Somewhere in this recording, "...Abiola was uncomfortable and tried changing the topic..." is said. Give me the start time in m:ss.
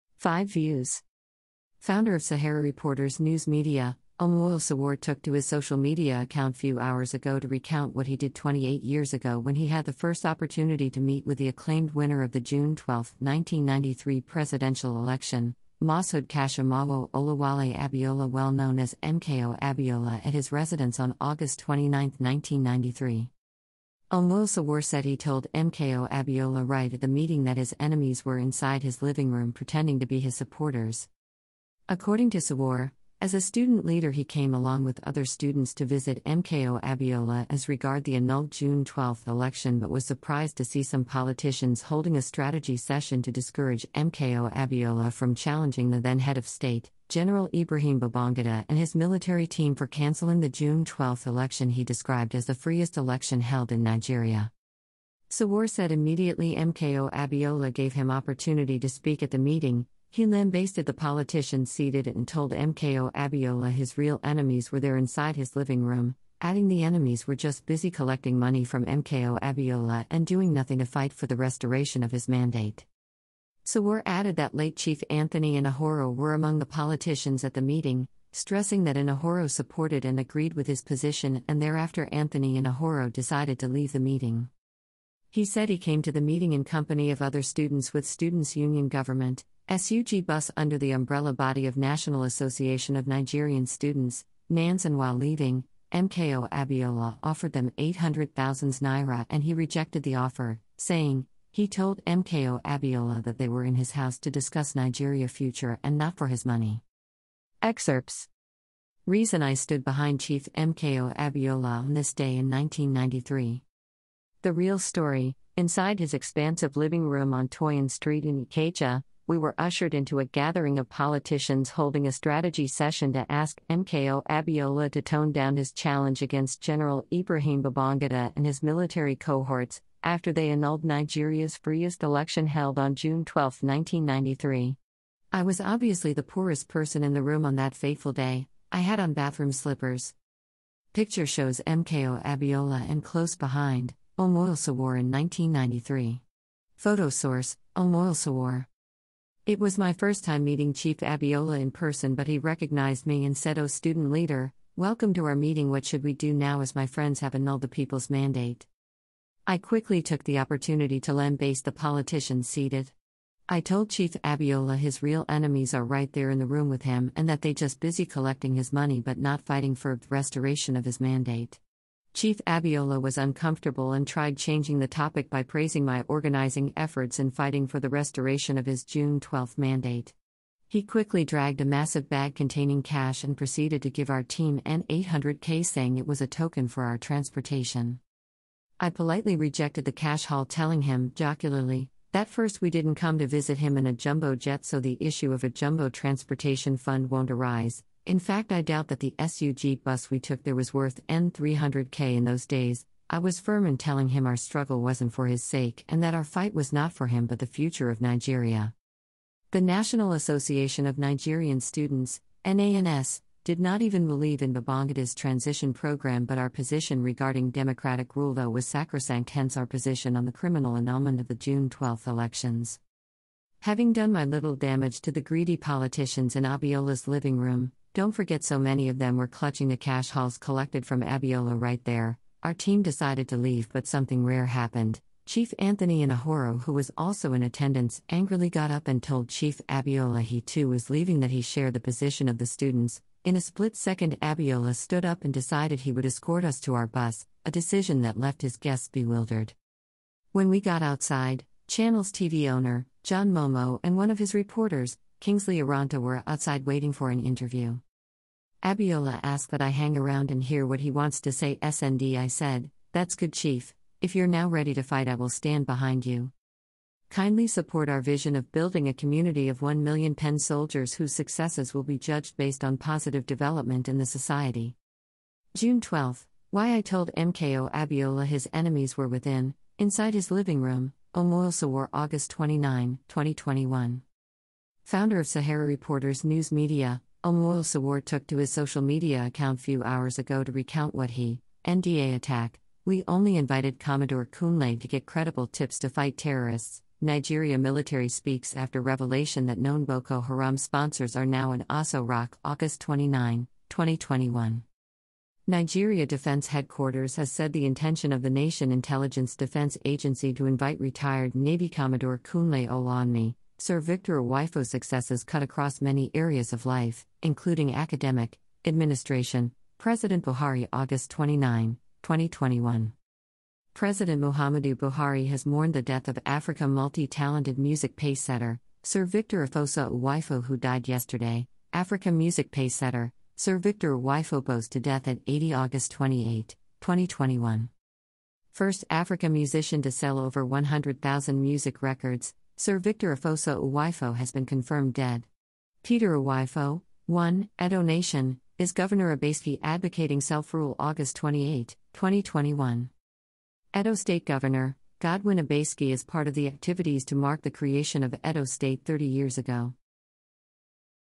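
2:52.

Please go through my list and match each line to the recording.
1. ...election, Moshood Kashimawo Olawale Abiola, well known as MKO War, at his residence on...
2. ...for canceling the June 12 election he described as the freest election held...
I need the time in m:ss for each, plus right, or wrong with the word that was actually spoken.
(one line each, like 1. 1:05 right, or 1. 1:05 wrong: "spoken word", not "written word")
1. 0:14 wrong: "Abiola", not "War"
2. 0:49 right.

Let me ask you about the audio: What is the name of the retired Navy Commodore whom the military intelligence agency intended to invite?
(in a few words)
Kunle Olawunmi.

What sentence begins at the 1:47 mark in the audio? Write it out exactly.
Excerpts Reason I stood behind Chief MKO Abiola on this day in 1993.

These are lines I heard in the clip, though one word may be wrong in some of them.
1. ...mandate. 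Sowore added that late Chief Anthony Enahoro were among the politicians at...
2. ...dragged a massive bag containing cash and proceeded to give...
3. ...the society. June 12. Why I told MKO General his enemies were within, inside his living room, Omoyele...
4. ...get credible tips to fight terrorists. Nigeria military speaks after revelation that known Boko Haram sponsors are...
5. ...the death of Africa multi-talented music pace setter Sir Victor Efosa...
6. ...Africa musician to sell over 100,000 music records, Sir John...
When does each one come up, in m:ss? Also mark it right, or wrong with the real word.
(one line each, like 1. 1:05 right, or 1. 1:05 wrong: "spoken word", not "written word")
1. 1:12 right
2. 3:01 right
3. 4:33 wrong: "Abiola", not "General"
4. 4:54 right
5. 5:25 right
6. 5:38 wrong: "Victor", not "John".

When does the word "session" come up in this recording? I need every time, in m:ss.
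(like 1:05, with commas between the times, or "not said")
0:42, 2:02.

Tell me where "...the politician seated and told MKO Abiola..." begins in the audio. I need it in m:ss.
1:00.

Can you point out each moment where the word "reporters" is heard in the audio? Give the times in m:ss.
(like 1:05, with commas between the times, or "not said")
0:02, 4:14, 4:45.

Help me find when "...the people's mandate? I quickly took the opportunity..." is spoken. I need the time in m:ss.
2:37.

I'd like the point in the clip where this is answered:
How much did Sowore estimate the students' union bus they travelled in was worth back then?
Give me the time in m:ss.
3:21.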